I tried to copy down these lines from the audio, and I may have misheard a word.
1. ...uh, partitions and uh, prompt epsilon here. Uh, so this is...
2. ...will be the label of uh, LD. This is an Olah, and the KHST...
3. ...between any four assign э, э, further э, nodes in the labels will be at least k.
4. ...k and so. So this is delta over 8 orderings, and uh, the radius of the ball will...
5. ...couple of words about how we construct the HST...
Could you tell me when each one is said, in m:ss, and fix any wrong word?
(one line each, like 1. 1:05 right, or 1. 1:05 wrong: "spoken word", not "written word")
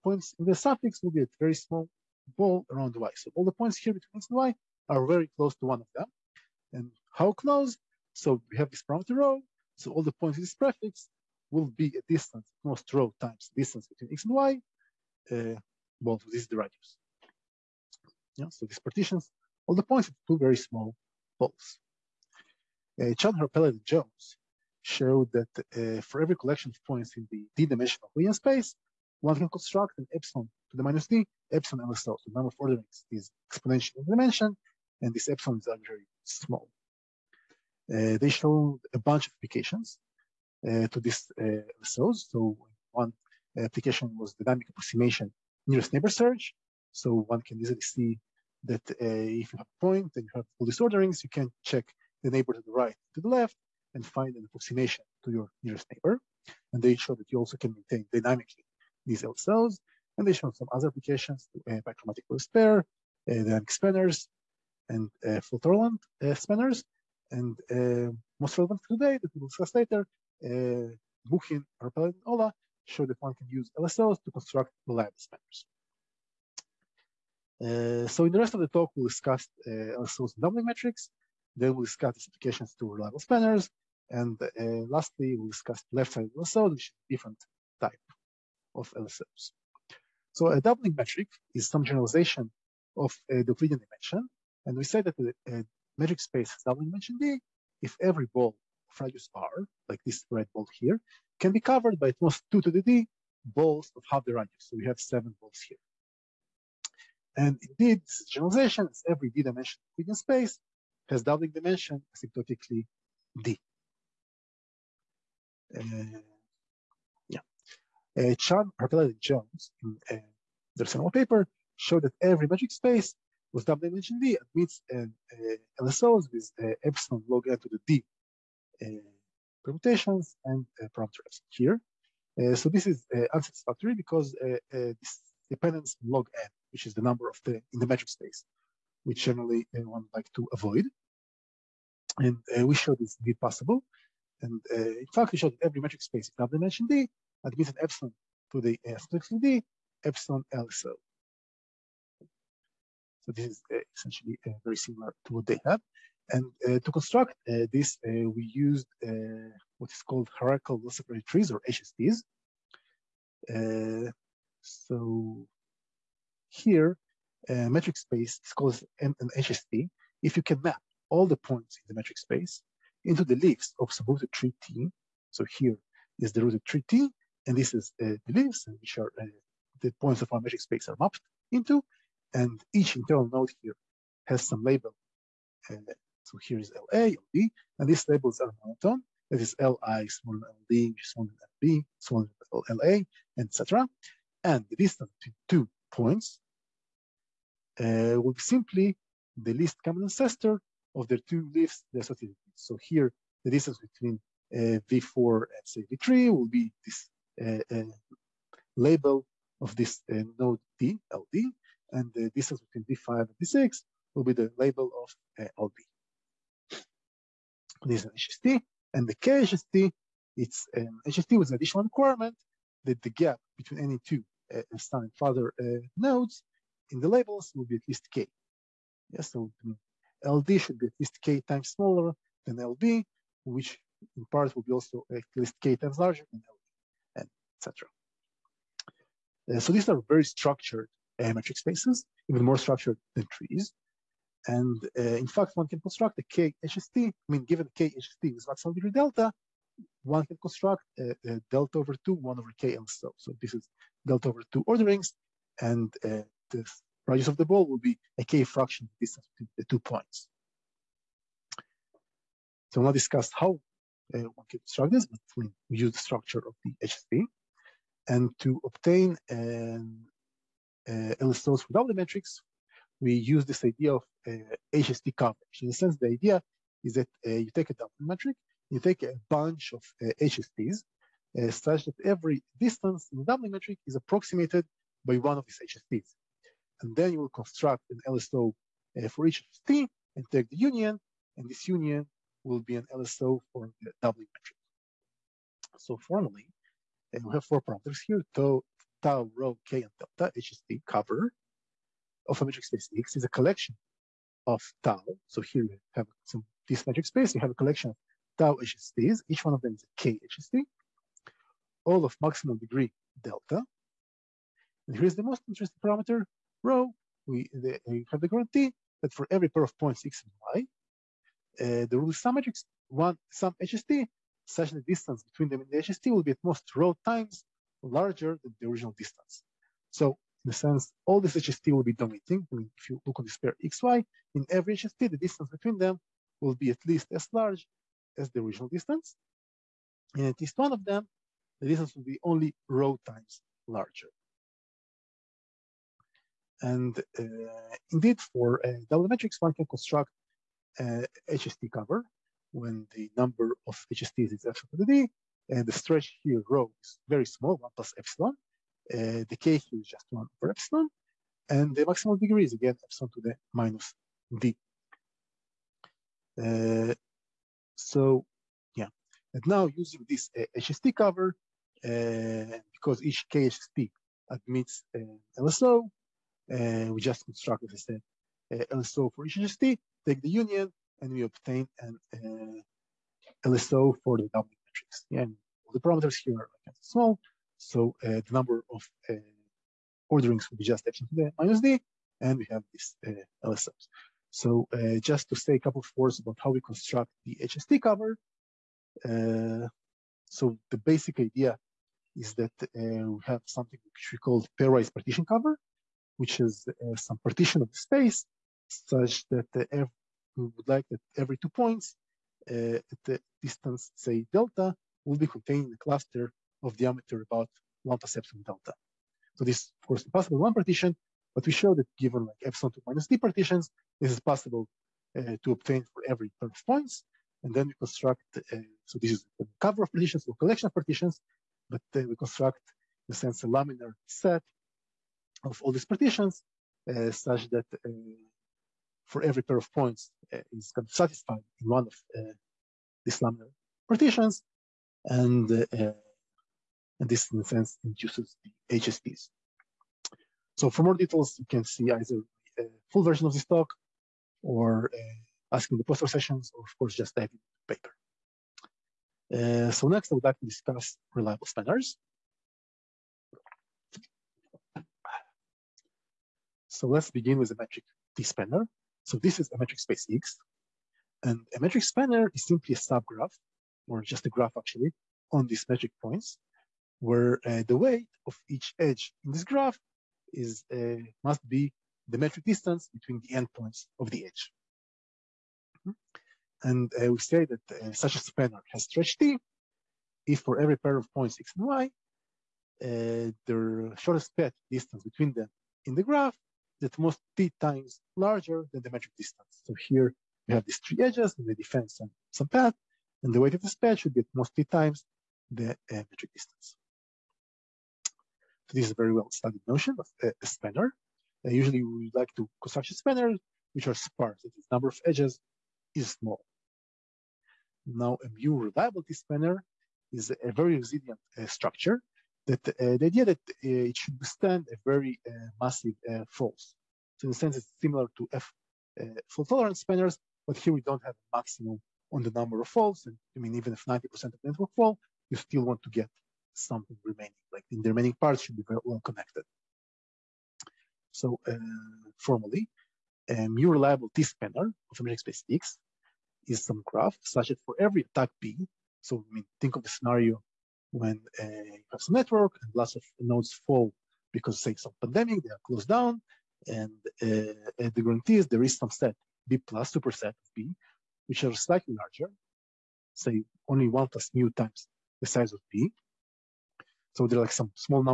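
1. 2:08 wrong: "permutations", not "partitions"
2. 3:34 wrong: "HST", not "Olah"
3. 3:43 wrong: "two", not "four"
4. 4:12 wrong: "2", not "8"
5. 6:35 right.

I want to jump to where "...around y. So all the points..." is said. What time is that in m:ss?
0:02.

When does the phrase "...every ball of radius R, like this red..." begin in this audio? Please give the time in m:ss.
1:38.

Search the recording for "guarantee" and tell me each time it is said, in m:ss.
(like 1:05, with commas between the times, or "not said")
5:18, 9:18.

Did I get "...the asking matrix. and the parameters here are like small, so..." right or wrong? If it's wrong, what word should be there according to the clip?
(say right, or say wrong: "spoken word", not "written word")
wrong: "doubling", not "asking".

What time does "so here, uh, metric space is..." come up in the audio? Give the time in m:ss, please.
2:44.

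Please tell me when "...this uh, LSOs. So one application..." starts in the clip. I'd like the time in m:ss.
0:41.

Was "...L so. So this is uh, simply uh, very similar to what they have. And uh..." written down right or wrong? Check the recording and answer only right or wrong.
wrong.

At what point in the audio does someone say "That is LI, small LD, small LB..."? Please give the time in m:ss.
3:09.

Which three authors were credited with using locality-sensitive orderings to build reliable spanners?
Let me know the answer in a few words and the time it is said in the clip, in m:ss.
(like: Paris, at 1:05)
Buchin, Har-Peled, and Olah, at 1:11.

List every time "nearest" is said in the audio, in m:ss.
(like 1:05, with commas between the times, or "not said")
0:45, 0:55.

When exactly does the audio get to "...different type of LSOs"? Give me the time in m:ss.
1:27.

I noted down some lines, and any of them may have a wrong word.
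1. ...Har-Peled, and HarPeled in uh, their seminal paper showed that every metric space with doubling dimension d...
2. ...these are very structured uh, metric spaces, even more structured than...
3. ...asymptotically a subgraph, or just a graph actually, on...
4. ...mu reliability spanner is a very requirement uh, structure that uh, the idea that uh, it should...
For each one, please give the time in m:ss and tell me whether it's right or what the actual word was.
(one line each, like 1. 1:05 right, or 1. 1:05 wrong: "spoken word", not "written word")
1. 1:58 wrong: "Jones", not "HarPeled"
2. 3:59 right
3. 7:52 wrong: "simply", not "asymptotically"
4. 8:38 wrong: "resilient", not "requirement".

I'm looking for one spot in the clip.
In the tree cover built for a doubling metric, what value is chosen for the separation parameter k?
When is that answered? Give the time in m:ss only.
6:00.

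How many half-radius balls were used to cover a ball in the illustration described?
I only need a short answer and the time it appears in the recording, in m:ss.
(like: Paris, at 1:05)
7, at 1:44.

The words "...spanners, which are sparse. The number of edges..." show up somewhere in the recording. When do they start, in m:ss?
8:32.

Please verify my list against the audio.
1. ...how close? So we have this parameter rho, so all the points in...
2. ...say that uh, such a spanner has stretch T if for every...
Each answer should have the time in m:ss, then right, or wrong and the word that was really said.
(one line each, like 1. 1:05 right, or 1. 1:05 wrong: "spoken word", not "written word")
1. 0:07 right
2. 8:07 right.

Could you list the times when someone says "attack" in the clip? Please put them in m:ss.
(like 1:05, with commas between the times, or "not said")
9:08.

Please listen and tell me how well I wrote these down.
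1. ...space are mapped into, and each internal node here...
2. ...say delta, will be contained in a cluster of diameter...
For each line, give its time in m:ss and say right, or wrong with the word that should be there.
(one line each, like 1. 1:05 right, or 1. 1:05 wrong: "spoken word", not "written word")
1. 3:00 right
2. 6:53 right.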